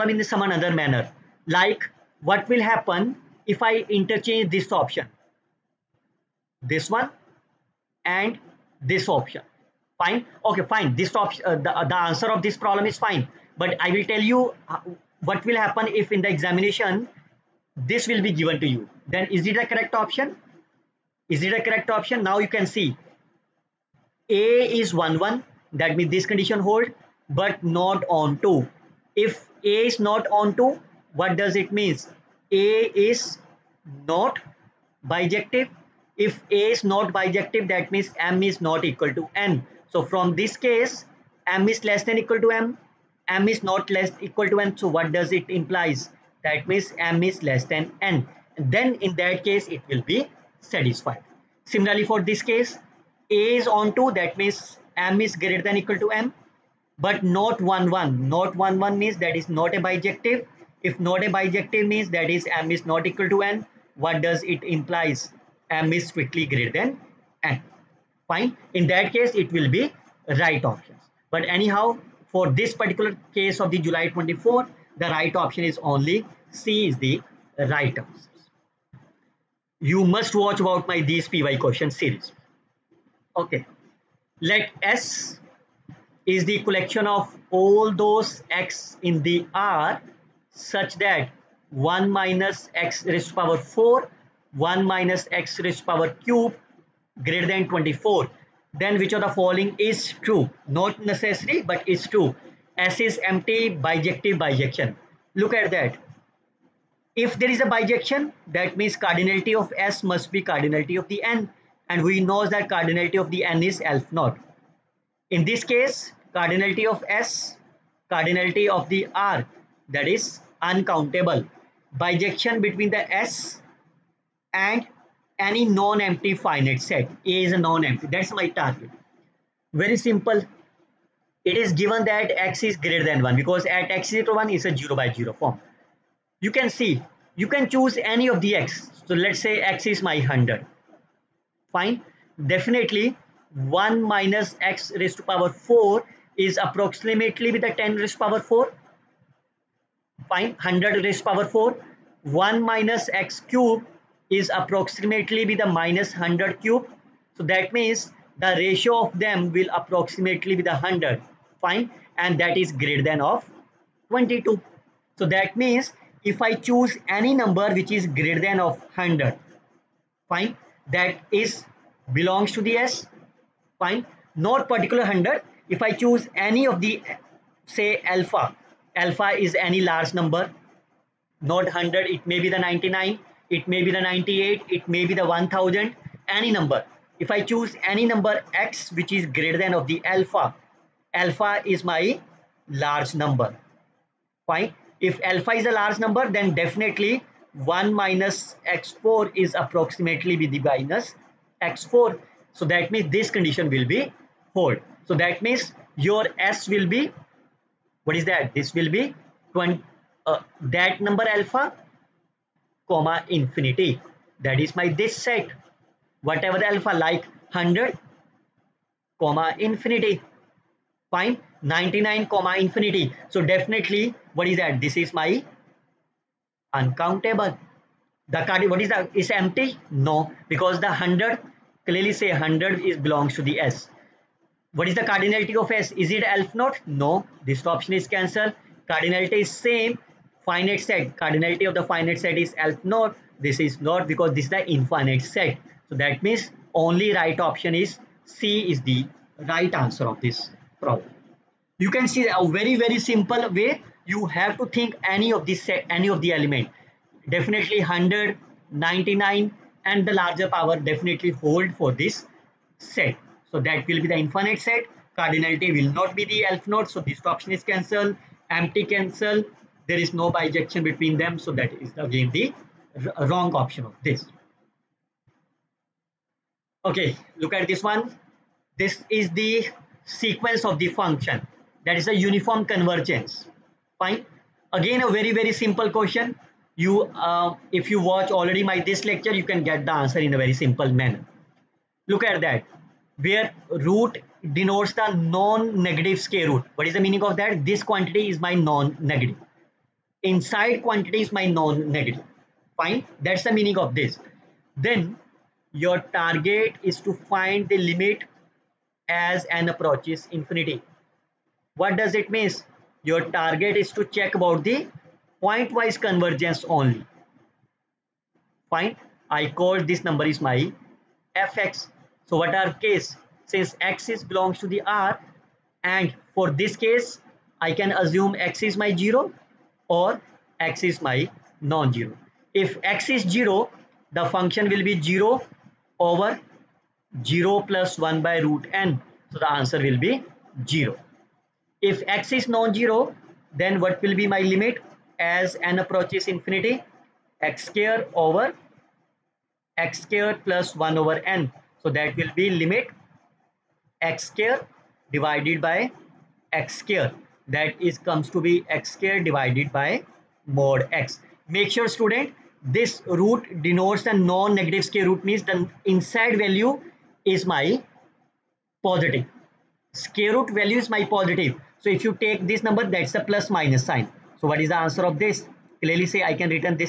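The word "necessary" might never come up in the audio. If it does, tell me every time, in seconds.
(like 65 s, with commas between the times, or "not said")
101 s.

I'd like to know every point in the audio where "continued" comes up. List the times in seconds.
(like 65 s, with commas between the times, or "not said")
not said.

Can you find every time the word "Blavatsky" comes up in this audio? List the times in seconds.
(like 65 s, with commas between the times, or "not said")
not said.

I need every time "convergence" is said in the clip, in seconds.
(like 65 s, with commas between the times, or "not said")
282 s, 315 s.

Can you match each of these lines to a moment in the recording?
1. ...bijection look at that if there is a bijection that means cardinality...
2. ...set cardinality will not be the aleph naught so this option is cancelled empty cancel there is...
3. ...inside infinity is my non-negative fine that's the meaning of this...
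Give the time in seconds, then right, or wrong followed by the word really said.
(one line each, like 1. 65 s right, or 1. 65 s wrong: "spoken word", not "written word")
1. 104 s right
2. 264 s right
3. 300 s wrong: "quantity", not "infinity".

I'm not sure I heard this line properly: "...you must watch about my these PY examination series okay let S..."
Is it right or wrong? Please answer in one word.
wrong.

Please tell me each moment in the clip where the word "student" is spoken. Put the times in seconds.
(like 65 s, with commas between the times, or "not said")
361 s.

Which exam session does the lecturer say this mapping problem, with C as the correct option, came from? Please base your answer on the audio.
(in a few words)
July 24.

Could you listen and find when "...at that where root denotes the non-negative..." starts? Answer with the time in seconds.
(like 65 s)
292 s.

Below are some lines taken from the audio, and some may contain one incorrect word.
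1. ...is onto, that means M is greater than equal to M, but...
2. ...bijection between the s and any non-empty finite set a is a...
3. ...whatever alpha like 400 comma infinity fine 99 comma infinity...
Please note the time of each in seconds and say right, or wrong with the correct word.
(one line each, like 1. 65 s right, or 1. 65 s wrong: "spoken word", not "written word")
1. 53 s right
2. 122 s right
3. 216 s wrong: "100", not "400".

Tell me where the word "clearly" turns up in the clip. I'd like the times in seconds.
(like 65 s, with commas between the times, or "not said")
231 s, 375 s.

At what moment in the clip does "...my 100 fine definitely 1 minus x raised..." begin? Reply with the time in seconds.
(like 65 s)
140 s.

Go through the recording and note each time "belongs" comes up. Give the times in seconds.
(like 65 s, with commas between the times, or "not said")
172 s, 233 s, 324 s.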